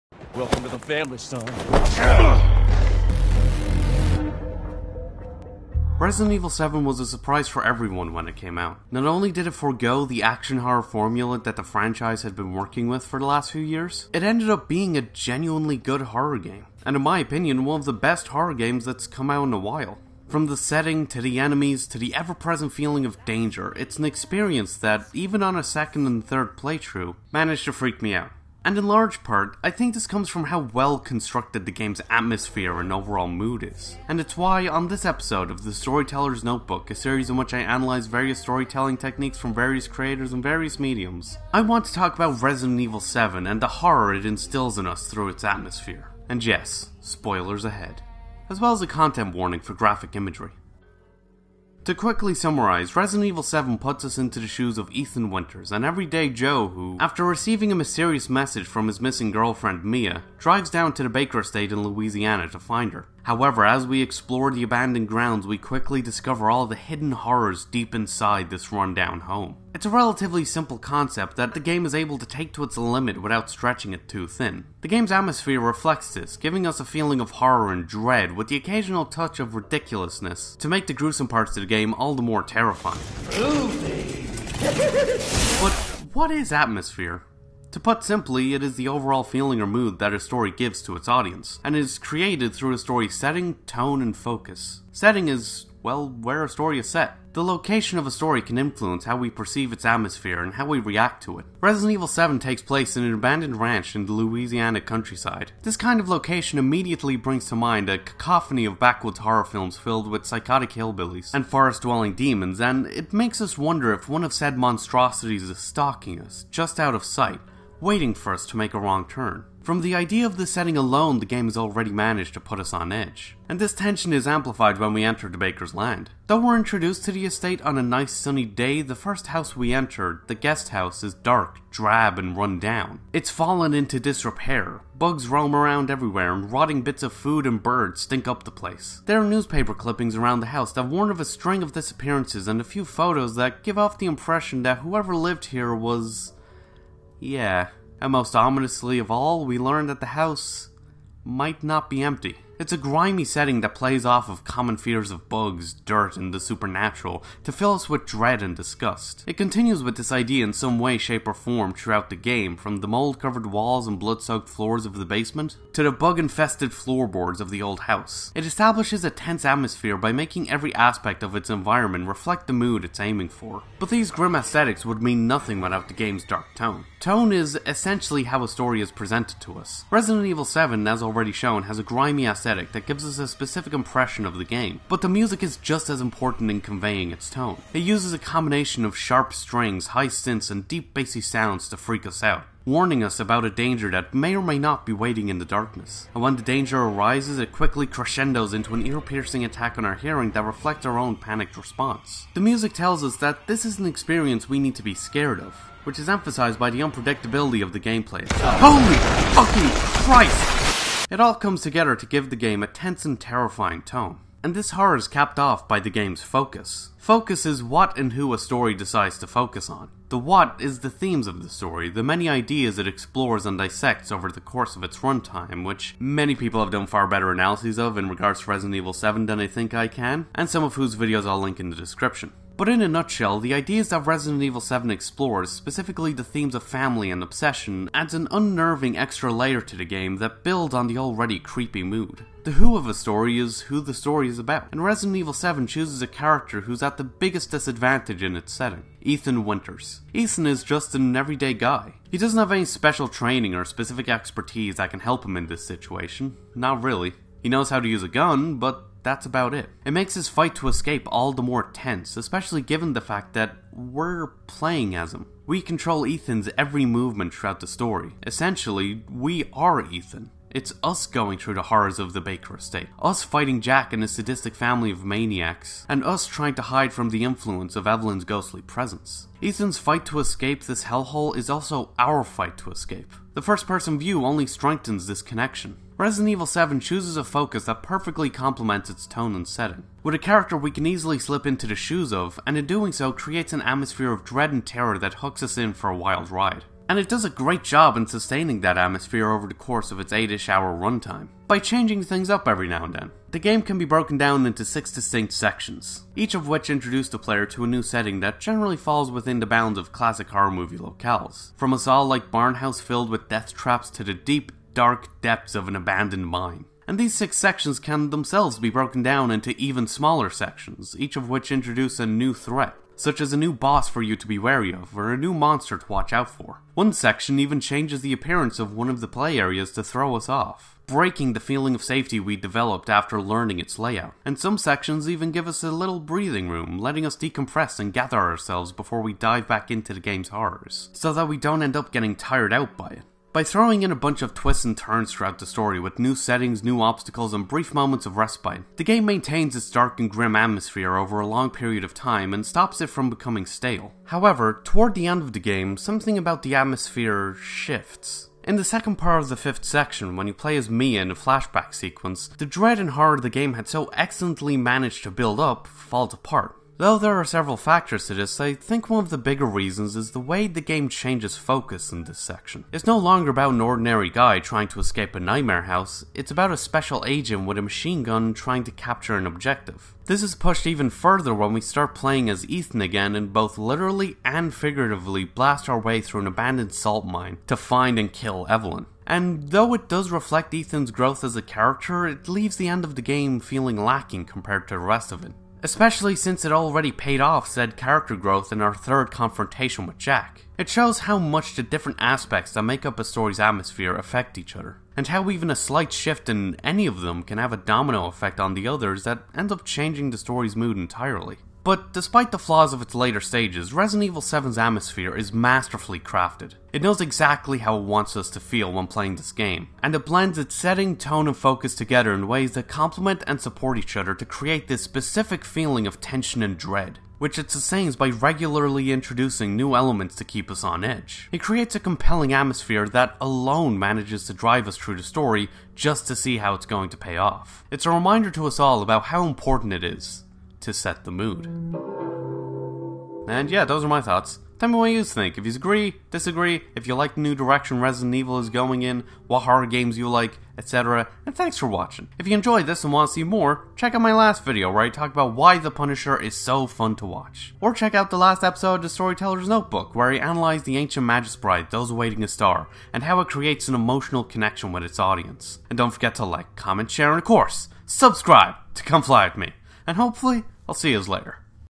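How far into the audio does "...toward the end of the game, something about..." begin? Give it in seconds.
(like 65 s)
354 s.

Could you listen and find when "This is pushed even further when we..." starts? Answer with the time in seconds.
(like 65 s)
380 s.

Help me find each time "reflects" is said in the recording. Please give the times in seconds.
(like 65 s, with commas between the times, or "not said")
75 s, 172 s, 200 s, 390 s.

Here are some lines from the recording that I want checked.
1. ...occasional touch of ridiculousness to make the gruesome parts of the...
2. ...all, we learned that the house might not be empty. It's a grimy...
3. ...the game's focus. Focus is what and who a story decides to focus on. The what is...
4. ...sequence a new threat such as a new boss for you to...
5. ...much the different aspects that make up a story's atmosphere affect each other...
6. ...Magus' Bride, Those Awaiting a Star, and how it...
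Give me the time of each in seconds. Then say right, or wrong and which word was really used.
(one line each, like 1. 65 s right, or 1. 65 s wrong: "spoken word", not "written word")
1. 78 s right
2. 149 s right
3. 215 s right
4. 321 s wrong: "introduce", not "sequence"
5. 401 s right
6. 461 s right.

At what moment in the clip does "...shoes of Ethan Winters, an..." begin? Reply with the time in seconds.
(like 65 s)
54 s.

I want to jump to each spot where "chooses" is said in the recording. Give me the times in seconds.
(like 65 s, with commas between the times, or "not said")
245 s, 286 s.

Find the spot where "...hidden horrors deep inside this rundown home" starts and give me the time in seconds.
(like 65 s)
66 s.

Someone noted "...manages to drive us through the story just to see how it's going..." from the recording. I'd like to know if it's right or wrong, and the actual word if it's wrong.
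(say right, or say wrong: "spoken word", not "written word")
right.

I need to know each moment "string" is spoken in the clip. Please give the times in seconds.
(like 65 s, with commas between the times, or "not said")
141 s, 189 s.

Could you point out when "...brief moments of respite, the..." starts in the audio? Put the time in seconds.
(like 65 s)
347 s.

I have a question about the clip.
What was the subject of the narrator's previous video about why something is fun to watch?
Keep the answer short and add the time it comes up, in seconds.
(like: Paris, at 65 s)
The Punisher, at 455 s.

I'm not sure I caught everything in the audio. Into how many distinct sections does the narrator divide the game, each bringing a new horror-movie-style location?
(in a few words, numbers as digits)
6.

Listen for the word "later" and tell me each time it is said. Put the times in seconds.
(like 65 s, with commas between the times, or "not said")
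412 s, 471 s.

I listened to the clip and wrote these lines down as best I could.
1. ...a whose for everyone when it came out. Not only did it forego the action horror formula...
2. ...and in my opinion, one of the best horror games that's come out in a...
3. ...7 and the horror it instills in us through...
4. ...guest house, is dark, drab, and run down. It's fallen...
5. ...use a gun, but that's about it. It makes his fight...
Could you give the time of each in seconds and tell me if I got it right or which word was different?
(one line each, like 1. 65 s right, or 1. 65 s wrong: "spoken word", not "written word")
1. 6 s wrong: "surprise", not "whose"
2. 16 s right
3. 42 s right
4. 130 s right
5. 257 s right.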